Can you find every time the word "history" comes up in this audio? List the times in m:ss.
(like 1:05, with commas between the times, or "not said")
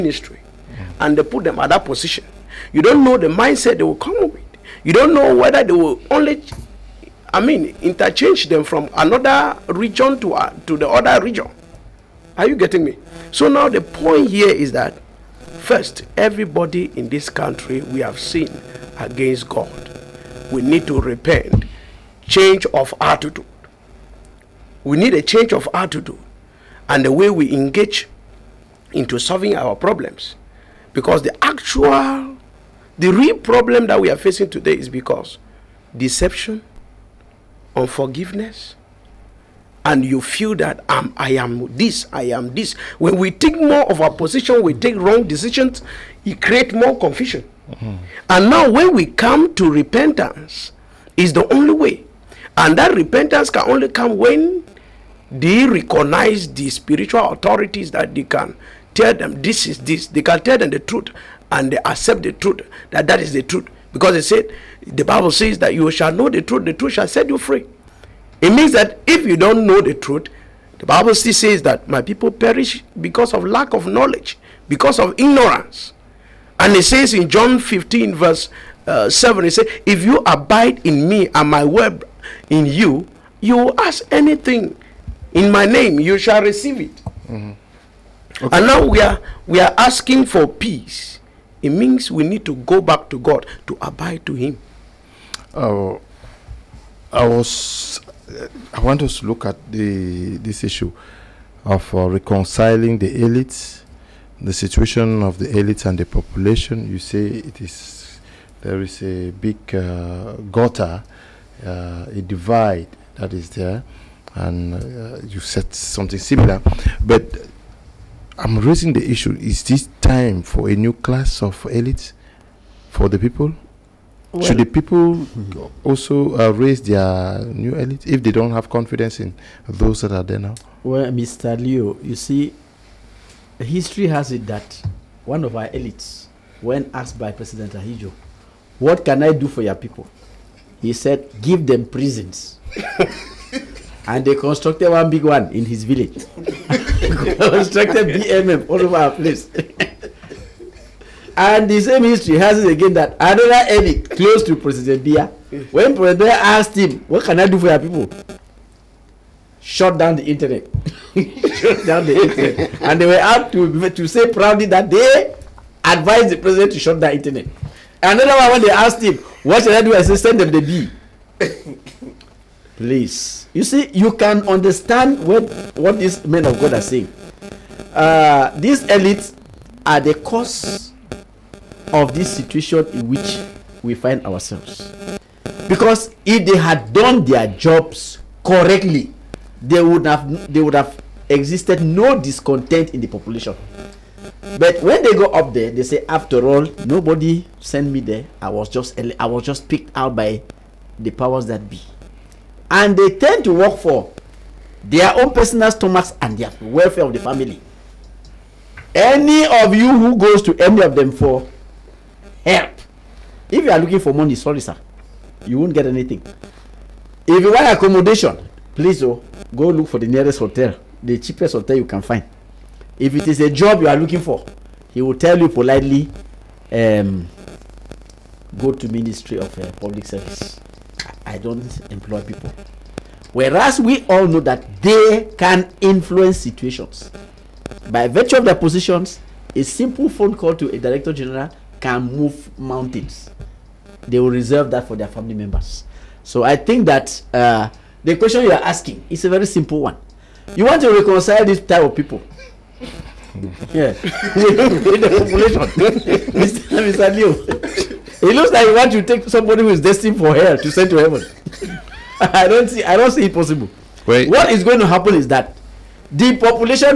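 2:13, 2:32.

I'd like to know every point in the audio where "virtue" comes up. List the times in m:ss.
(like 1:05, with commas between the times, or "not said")
3:58.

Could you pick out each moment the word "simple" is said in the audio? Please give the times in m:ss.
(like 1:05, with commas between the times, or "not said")
3:59, 4:09.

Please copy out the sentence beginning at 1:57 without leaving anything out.
But I'm raising the issue: is this time for a new class of elites for the people?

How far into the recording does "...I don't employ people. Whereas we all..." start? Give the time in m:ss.
3:51.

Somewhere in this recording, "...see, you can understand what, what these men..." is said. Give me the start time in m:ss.
2:53.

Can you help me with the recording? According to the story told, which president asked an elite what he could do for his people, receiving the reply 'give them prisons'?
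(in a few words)
Ahidjo.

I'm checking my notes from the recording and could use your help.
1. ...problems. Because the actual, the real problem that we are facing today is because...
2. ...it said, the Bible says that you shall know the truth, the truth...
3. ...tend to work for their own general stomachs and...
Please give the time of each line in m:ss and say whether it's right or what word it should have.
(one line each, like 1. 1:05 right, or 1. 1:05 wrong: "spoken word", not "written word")
1. 0:29 right
2. 1:04 right
3. 3:23 wrong: "personal", not "general".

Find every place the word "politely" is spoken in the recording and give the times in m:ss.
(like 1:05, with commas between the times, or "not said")
3:45.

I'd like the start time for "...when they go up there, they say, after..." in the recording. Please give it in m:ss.
3:14.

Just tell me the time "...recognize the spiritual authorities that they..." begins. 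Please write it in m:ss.
0:55.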